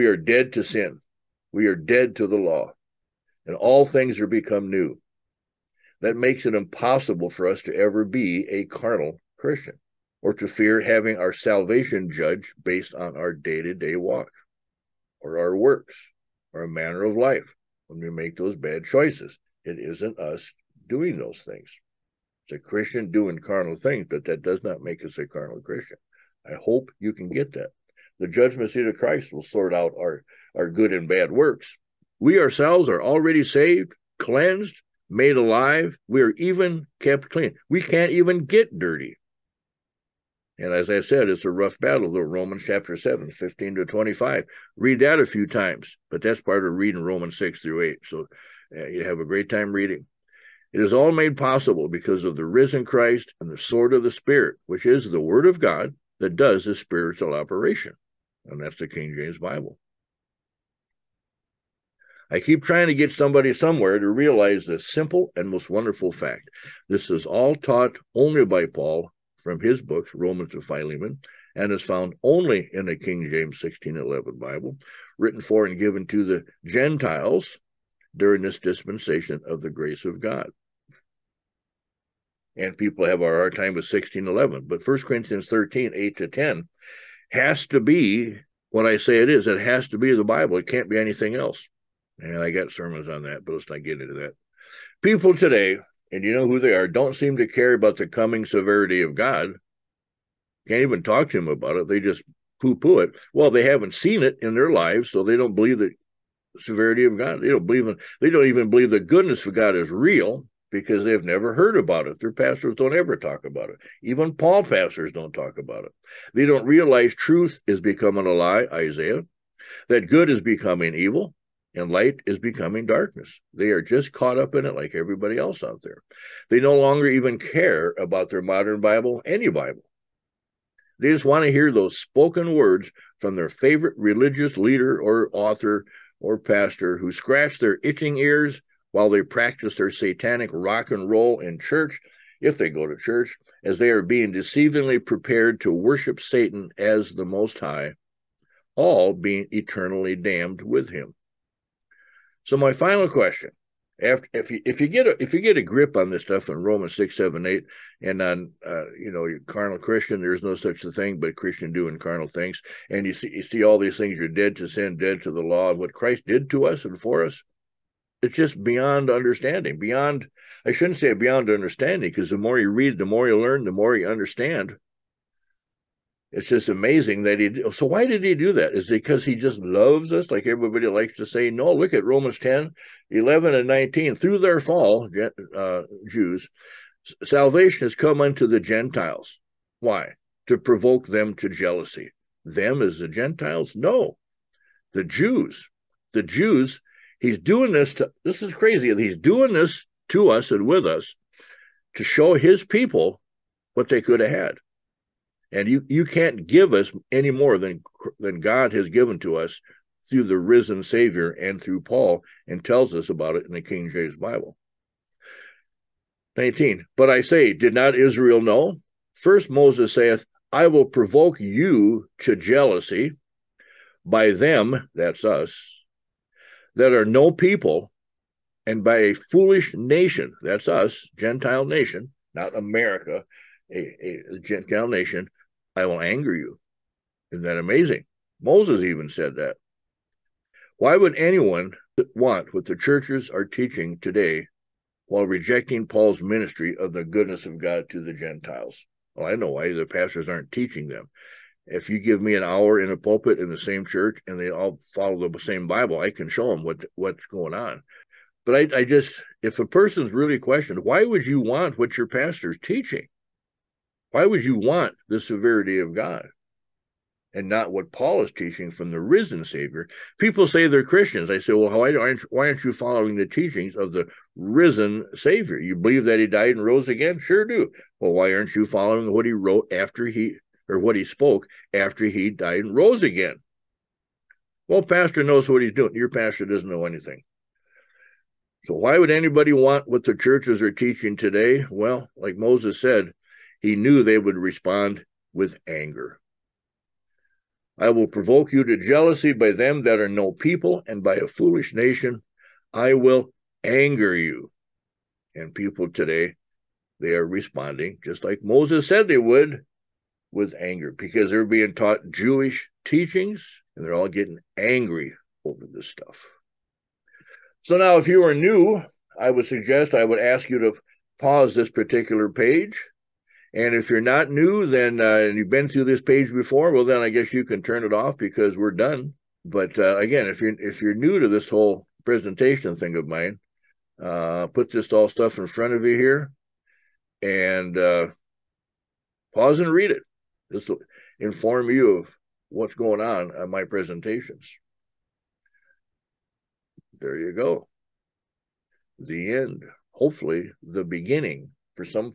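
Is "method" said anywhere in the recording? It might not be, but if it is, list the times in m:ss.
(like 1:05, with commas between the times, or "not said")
not said.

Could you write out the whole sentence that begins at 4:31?
I say, well, why aren't, why aren't you following the teachings of the risen Savior?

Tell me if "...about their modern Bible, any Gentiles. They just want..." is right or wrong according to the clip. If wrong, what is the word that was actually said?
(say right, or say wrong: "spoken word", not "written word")
wrong: "Bible", not "Gentiles".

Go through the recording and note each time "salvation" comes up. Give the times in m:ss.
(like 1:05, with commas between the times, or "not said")
0:11, 3:07.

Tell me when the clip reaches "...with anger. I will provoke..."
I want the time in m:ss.
4:55.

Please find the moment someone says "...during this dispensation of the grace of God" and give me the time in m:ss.
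1:18.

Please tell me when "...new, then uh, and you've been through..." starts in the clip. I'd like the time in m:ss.
5:24.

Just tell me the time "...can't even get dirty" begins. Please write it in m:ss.
0:37.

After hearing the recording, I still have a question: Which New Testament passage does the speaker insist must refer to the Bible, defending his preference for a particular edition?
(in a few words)
1 Corinthians 13:8-10.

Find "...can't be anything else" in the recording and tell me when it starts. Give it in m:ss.
1:30.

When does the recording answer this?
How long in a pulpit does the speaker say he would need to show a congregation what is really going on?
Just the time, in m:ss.
4:12.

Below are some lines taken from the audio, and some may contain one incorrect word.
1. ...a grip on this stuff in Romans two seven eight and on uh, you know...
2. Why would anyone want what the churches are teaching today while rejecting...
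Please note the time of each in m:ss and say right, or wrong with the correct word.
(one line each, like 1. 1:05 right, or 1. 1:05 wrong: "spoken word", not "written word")
1. 2:35 wrong: "six", not "two"
2. 4:00 right.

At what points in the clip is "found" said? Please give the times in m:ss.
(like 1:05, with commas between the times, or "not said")
1:11.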